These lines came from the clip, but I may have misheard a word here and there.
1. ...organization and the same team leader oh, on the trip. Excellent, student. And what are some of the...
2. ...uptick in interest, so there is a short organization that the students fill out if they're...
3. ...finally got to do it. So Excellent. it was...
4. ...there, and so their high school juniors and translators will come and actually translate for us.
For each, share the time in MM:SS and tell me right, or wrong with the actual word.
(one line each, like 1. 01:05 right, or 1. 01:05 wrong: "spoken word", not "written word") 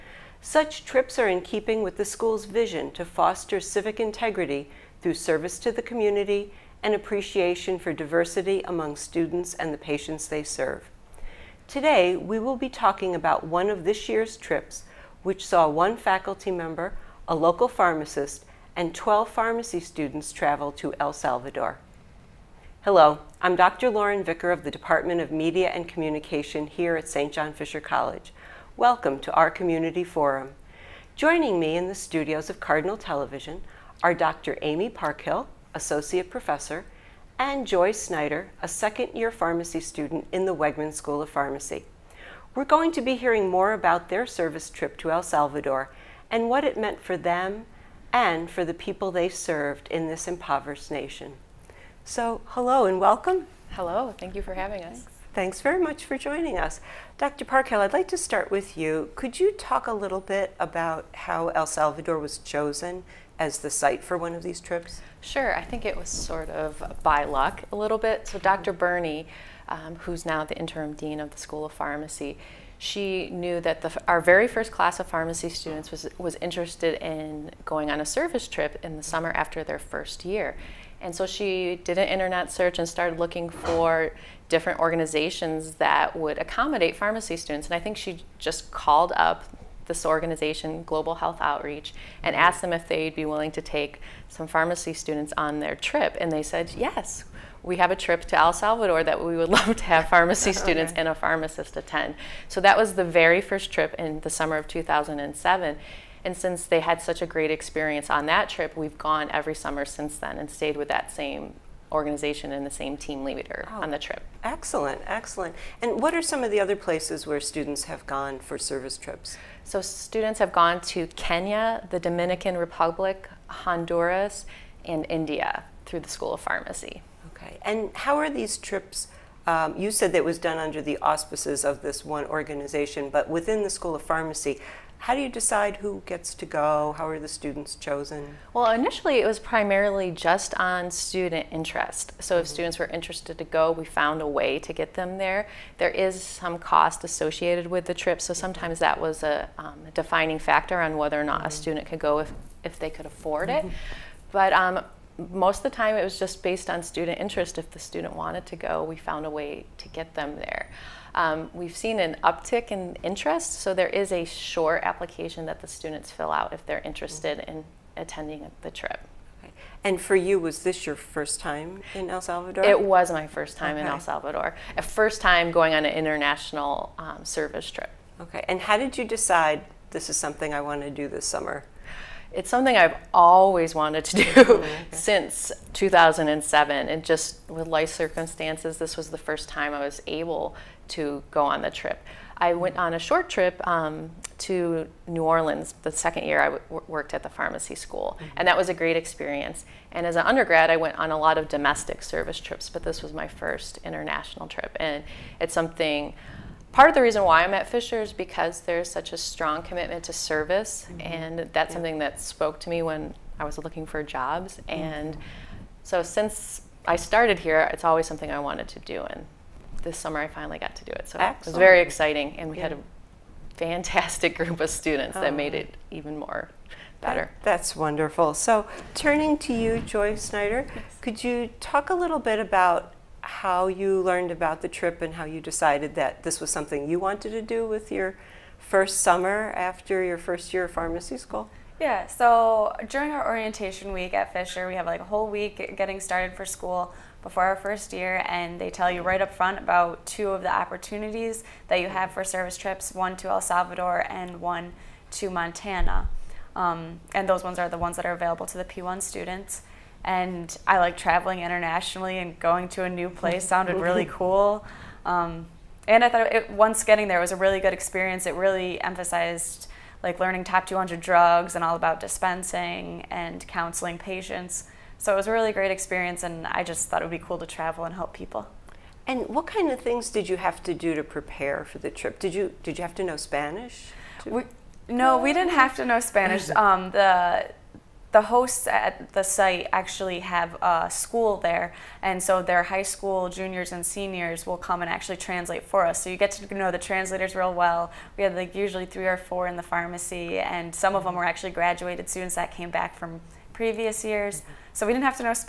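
1. 01:51 wrong: "excellent", not "student"
2. 02:42 wrong: "application", not "organization"
3. 03:40 right
4. 04:51 wrong: "seniors", not "translators".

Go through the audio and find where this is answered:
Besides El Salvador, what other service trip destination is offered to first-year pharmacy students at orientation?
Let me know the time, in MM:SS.
04:15.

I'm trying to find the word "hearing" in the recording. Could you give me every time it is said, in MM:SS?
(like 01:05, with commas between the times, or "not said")
00:43.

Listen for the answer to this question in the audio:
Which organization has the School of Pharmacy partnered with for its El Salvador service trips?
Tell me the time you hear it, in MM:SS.
01:30.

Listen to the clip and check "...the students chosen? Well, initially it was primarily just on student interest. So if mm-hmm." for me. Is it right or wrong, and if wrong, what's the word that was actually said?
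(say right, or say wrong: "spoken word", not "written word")
right.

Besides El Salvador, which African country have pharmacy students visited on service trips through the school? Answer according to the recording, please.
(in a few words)
Kenya.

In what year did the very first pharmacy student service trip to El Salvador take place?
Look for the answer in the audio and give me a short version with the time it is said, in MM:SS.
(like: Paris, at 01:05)
2007, at 01:44.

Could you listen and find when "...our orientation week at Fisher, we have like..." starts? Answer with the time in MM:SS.
04:03.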